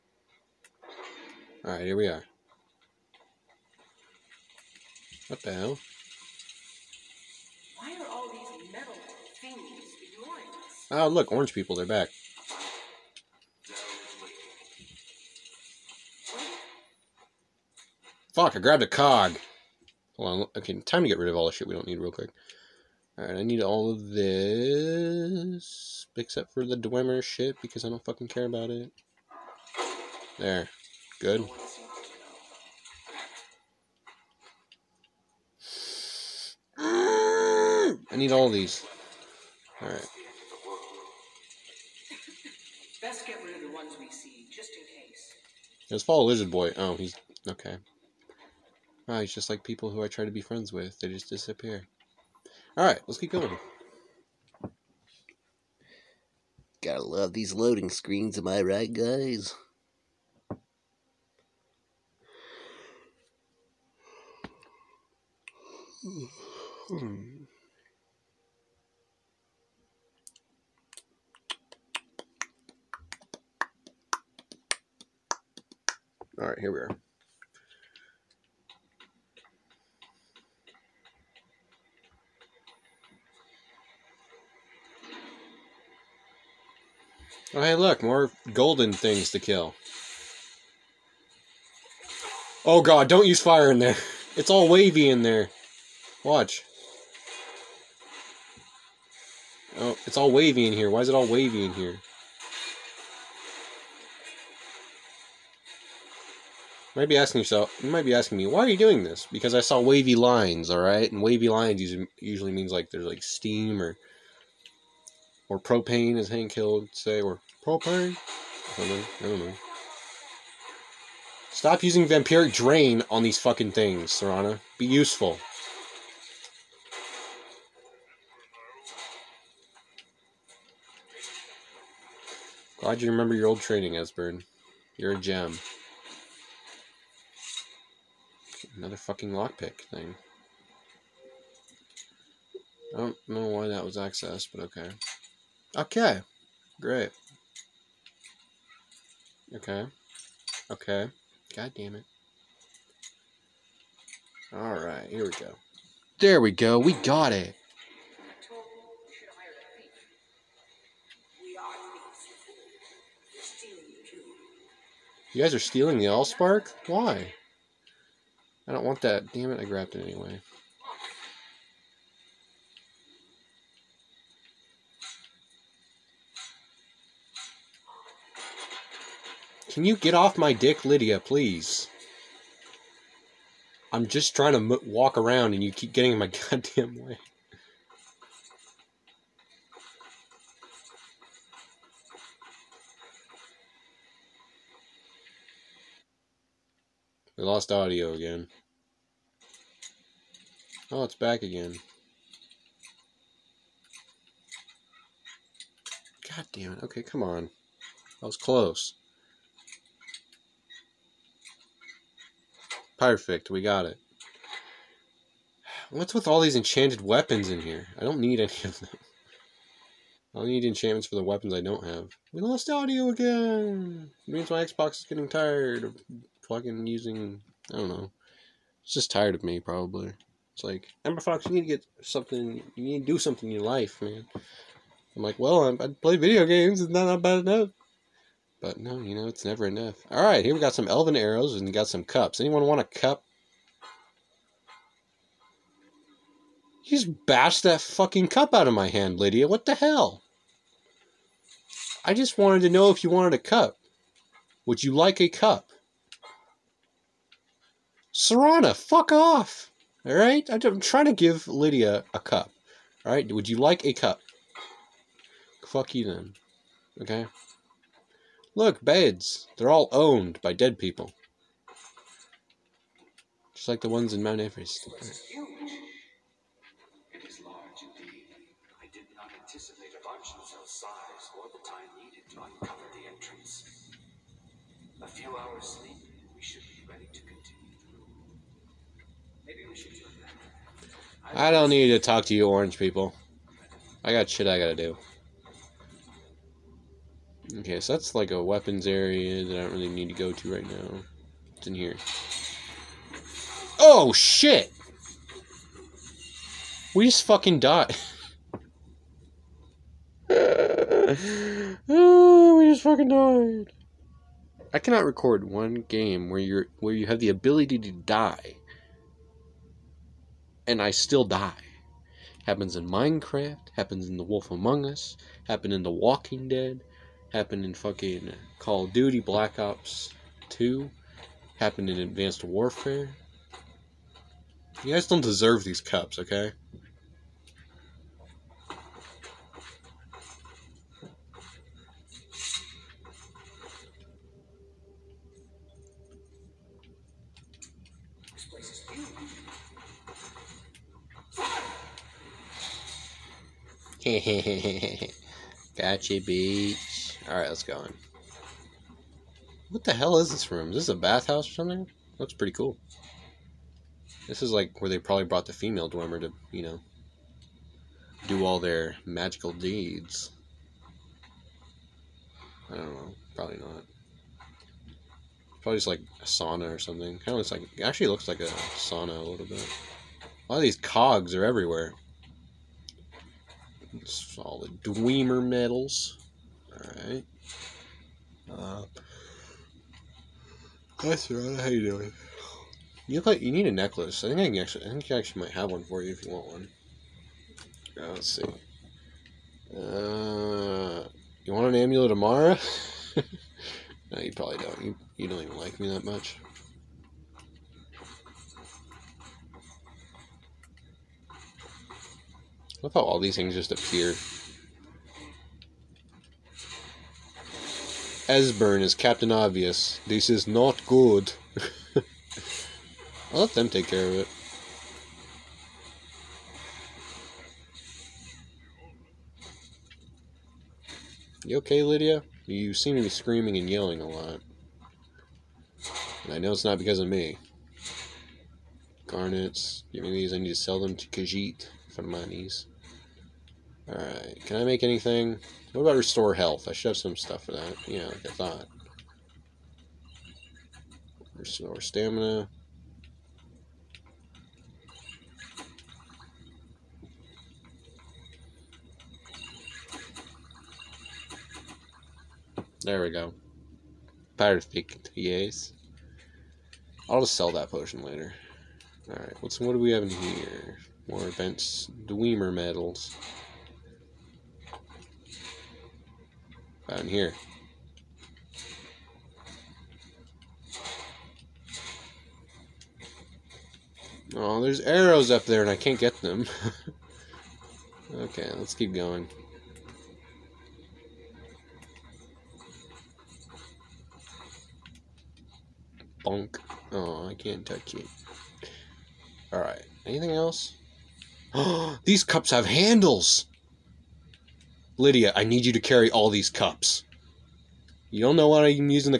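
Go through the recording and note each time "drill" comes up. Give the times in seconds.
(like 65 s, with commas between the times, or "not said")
not said.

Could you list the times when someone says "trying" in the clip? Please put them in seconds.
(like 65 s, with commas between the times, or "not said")
184 s, 260 s.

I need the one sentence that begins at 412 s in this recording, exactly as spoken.
I thought all these things just appear.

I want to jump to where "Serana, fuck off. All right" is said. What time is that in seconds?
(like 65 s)
258 s.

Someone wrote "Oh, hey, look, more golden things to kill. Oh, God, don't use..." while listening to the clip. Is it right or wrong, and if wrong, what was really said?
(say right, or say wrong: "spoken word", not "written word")
right.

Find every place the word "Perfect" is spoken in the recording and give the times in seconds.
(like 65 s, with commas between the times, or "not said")
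212 s, 464 s.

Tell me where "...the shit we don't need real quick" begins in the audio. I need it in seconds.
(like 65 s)
21 s.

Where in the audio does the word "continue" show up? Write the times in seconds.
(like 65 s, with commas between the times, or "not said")
287 s.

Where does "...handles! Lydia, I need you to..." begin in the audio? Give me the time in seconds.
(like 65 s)
502 s.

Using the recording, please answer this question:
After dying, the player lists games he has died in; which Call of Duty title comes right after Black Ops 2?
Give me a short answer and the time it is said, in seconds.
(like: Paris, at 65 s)
Advanced Warfare, at 331 s.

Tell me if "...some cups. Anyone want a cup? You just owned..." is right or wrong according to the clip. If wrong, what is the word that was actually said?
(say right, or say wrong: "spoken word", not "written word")
wrong: "bashed", not "owned".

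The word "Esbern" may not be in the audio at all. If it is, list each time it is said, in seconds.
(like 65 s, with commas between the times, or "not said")
133 s, 418 s.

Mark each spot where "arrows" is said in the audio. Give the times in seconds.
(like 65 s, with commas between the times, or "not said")
241 s, 484 s.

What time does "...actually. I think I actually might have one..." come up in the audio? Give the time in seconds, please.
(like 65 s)
394 s.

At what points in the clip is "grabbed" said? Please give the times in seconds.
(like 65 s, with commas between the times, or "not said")
18 s, 169 s.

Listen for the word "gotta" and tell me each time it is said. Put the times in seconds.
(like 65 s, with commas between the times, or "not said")
56 s, 294 s.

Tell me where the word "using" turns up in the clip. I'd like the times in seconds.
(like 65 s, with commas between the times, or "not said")
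121 s, 226 s.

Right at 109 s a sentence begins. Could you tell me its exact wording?
Because I saw wavy lines, all right?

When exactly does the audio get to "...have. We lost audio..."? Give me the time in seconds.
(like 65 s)
221 s.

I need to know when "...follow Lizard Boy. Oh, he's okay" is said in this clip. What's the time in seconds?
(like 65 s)
46 s.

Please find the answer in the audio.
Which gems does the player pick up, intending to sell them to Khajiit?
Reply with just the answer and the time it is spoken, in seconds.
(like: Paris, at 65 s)
Garnets, at 439 s.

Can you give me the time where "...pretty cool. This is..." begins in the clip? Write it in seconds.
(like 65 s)
362 s.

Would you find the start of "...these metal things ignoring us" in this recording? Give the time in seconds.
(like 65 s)
8 s.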